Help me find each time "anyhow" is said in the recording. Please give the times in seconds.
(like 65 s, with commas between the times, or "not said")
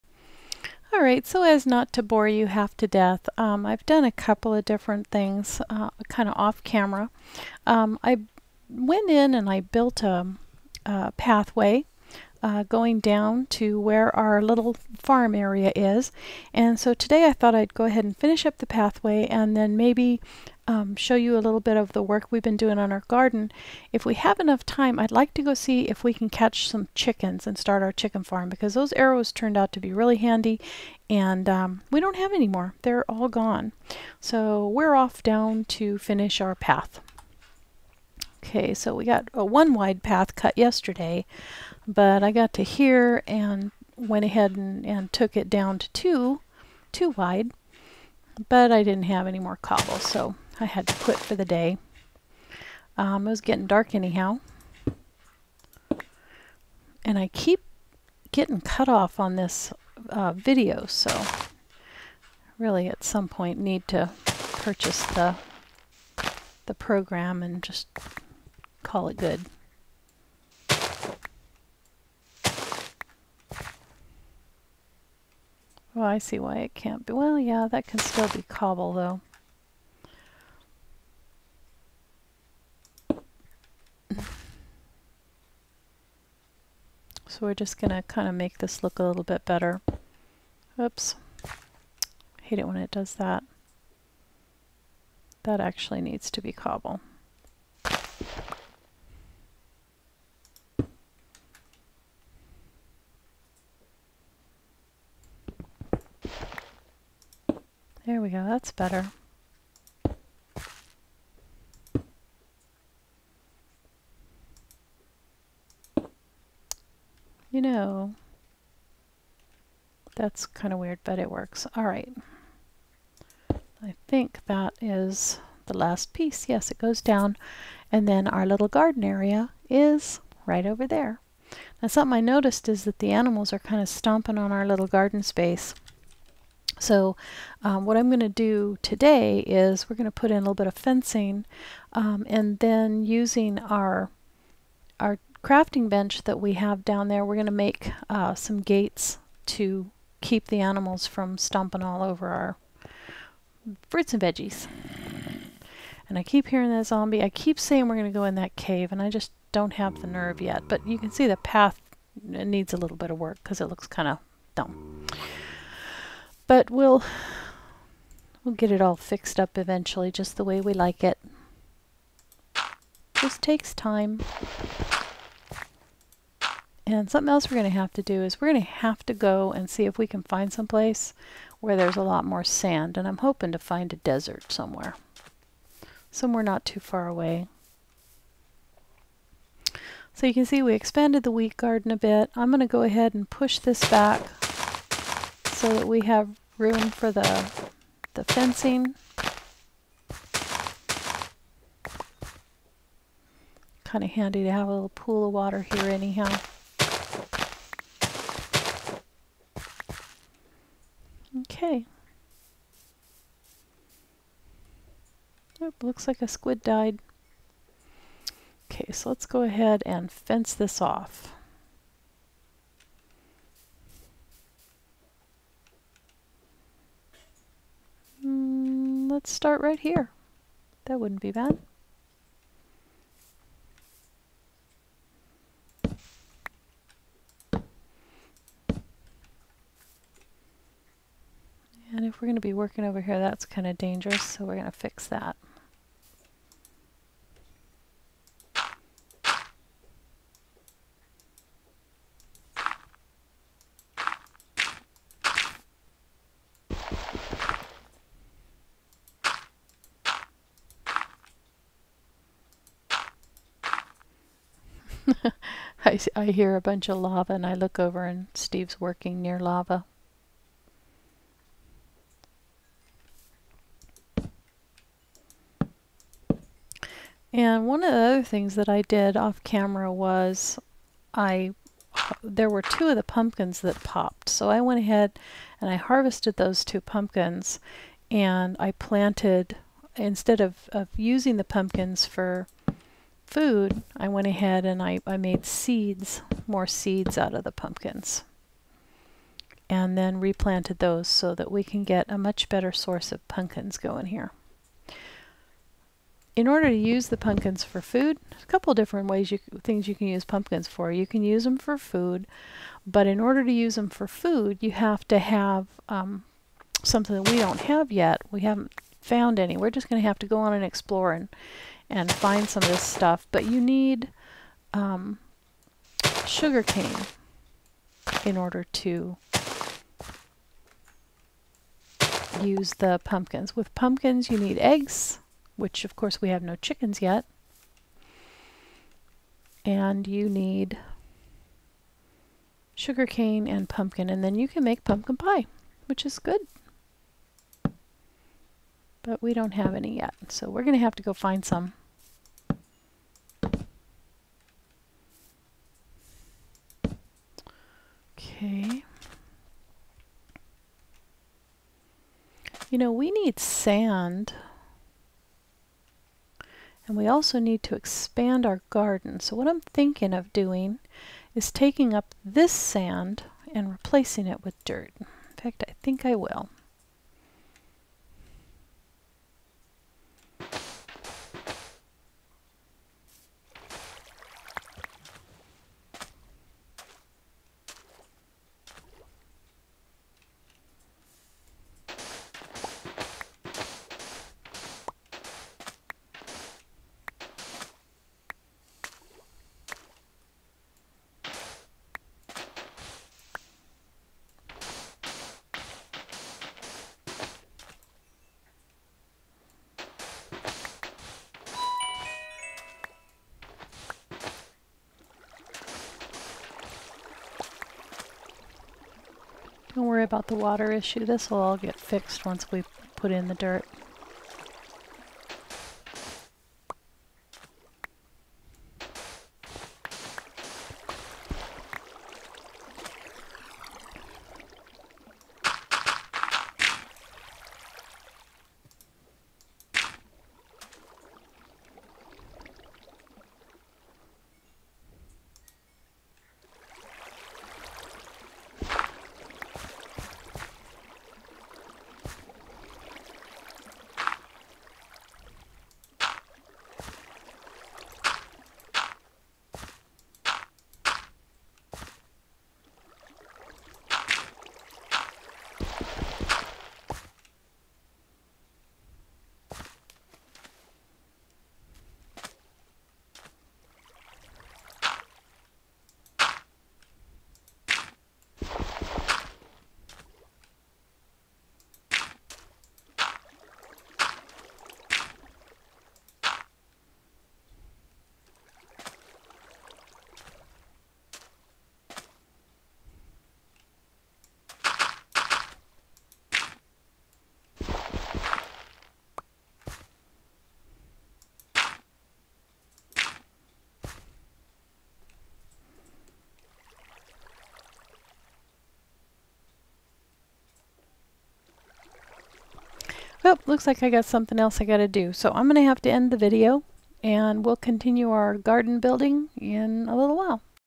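53 s, 205 s.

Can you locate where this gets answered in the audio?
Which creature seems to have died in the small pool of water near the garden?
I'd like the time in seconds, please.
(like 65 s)
216 s.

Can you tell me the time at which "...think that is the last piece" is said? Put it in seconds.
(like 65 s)
124 s.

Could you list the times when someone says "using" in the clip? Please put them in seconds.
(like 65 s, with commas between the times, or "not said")
143 s, 290 s.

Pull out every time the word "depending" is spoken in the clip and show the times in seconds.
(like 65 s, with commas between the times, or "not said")
not said.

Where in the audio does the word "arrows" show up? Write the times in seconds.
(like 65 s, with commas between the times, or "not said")
28 s.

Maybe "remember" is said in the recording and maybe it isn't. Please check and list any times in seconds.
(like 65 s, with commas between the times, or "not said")
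not said.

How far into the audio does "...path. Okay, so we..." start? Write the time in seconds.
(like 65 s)
36 s.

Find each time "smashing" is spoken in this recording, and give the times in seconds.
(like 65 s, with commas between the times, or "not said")
not said.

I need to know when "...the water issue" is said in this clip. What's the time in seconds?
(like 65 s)
420 s.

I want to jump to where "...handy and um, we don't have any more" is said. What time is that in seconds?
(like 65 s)
30 s.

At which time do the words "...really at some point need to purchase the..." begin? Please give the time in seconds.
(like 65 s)
62 s.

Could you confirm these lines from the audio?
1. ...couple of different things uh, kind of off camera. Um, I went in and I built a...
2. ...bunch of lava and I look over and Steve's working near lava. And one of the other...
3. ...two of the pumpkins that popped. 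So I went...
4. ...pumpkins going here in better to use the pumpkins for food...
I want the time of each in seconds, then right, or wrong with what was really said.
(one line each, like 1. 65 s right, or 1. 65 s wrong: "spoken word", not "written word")
1. 4 s right
2. 266 s right
3. 282 s right
4. 303 s wrong: "order", not "better".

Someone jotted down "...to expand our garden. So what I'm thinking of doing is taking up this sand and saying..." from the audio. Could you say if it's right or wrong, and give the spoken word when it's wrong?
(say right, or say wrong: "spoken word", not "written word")
wrong: "replacing", not "saying".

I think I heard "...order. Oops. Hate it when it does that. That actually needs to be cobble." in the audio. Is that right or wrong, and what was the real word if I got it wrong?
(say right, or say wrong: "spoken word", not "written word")
wrong: "better", not "order".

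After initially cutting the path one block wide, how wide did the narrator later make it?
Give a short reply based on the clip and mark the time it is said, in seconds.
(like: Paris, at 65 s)
2, at 46 s.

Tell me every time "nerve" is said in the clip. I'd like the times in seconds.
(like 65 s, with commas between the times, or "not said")
160 s.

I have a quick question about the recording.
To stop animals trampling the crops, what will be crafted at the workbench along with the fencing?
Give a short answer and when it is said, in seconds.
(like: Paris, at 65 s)
Gates, at 148 s.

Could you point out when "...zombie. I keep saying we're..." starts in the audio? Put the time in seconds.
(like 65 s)
156 s.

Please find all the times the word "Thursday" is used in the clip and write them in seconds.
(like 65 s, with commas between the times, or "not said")
not said.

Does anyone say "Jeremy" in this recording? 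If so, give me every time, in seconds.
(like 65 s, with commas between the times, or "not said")
not said.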